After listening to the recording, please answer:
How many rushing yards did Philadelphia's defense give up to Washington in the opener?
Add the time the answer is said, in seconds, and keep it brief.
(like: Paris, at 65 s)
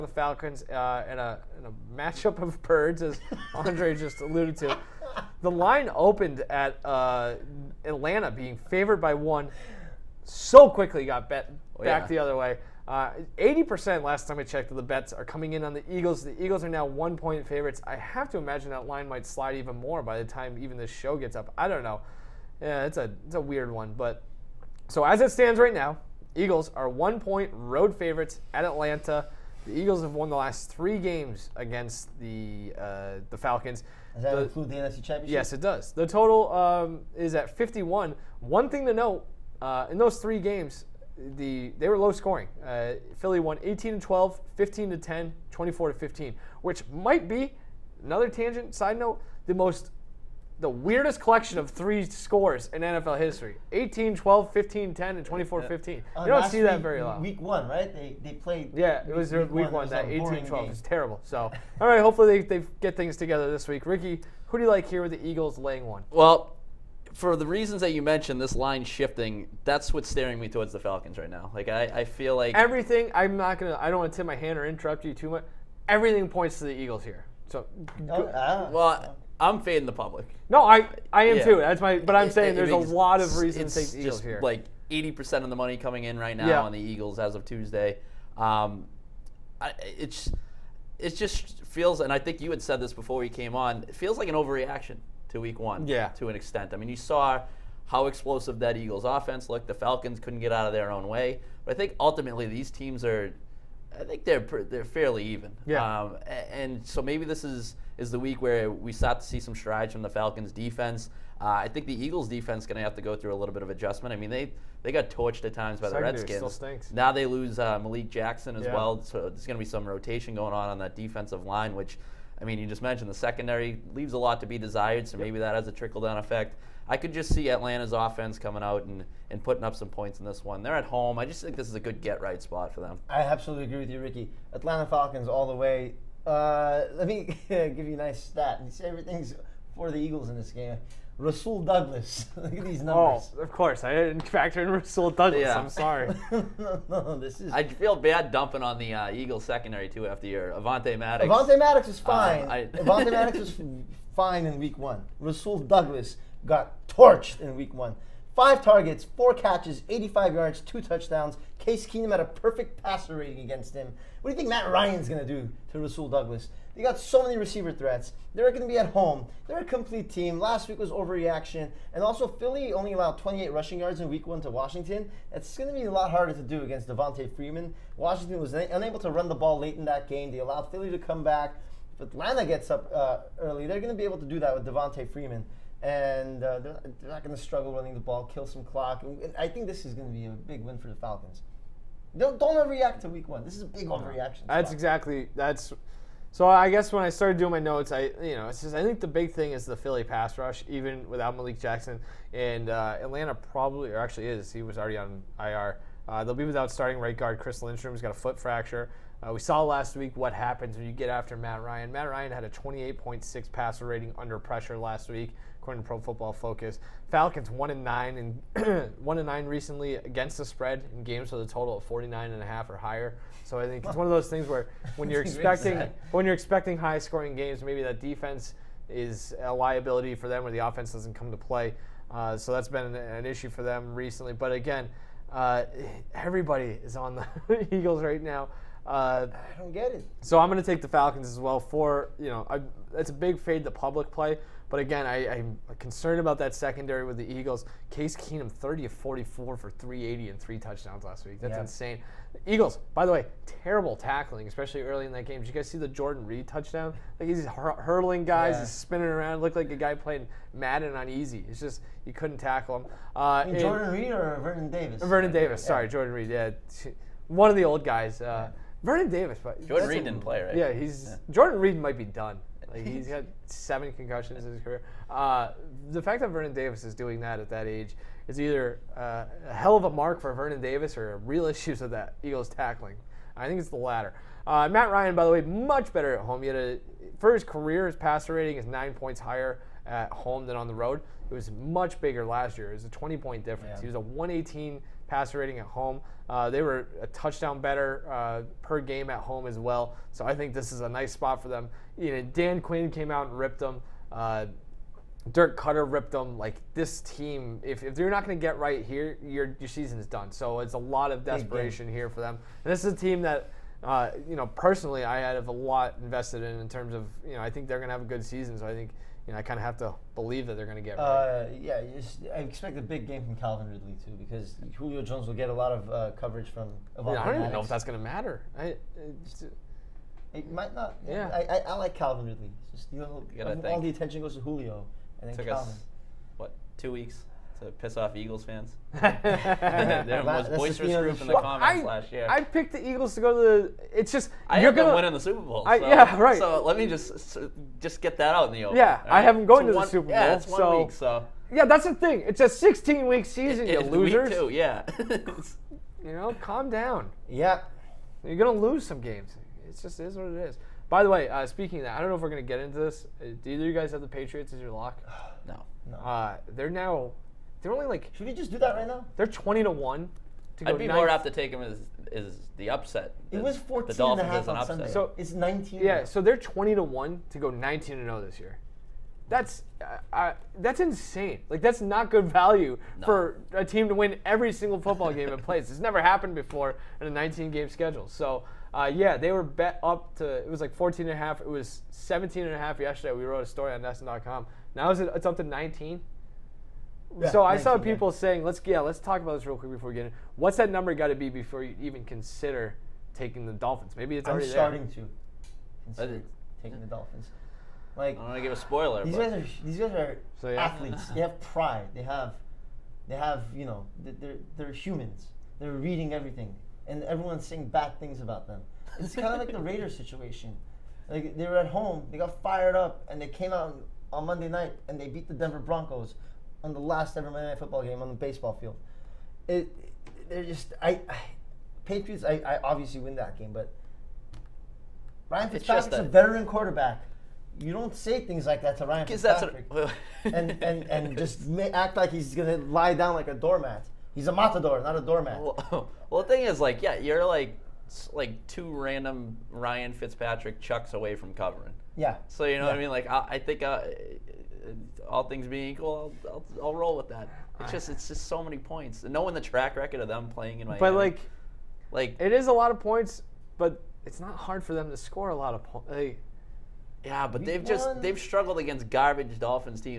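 28, at 173 s.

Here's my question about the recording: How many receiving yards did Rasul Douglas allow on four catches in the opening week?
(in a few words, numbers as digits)
85.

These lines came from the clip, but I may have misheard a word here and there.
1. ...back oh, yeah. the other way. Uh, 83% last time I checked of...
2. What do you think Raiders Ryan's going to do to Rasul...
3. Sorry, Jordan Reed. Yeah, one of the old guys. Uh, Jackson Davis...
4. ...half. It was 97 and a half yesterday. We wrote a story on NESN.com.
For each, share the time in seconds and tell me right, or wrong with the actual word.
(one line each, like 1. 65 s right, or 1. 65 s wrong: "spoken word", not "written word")
1. 11 s wrong: "80", not "83"
2. 164 s wrong: "Matt", not "Raiders"
3. 265 s wrong: "Vernon", not "Jackson"
4. 391 s wrong: "17", not "97".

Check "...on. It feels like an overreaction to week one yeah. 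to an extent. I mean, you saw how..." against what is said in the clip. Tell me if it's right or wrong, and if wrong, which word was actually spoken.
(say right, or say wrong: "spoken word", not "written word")
right.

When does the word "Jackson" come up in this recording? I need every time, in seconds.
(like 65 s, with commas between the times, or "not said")
118 s, 201 s.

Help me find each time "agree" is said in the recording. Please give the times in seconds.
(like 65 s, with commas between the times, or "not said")
133 s.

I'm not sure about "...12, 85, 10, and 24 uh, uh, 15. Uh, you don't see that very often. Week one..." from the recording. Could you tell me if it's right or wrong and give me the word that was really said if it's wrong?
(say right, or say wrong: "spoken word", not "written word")
wrong: "15", not "85".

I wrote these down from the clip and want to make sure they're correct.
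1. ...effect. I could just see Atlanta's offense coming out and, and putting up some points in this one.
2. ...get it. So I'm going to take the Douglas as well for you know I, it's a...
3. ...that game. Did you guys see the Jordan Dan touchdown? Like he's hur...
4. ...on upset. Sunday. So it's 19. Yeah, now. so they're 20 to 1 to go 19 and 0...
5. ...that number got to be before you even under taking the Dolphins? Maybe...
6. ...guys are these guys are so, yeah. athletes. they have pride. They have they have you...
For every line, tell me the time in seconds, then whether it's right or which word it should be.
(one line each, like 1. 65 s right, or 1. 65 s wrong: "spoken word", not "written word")
1. 126 s right
2. 239 s wrong: "Falcons", not "Douglas"
3. 255 s wrong: "Reed", not "Dan"
4. 374 s right
5. 400 s wrong: "consider", not "under"
6. 409 s right.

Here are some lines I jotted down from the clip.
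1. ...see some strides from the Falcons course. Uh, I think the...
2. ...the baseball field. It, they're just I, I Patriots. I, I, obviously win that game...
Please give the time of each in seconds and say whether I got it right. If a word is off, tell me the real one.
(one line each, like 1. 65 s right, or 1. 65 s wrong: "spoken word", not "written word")
1. 109 s wrong: "defense", not "course"
2. 428 s right.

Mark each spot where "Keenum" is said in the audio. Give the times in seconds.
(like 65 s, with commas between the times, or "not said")
161 s, 248 s.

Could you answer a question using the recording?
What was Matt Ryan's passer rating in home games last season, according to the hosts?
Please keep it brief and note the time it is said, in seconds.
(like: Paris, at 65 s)
118, at 293 s.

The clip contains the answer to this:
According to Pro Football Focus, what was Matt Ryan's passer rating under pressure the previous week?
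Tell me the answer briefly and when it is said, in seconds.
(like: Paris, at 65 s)
28.6, at 212 s.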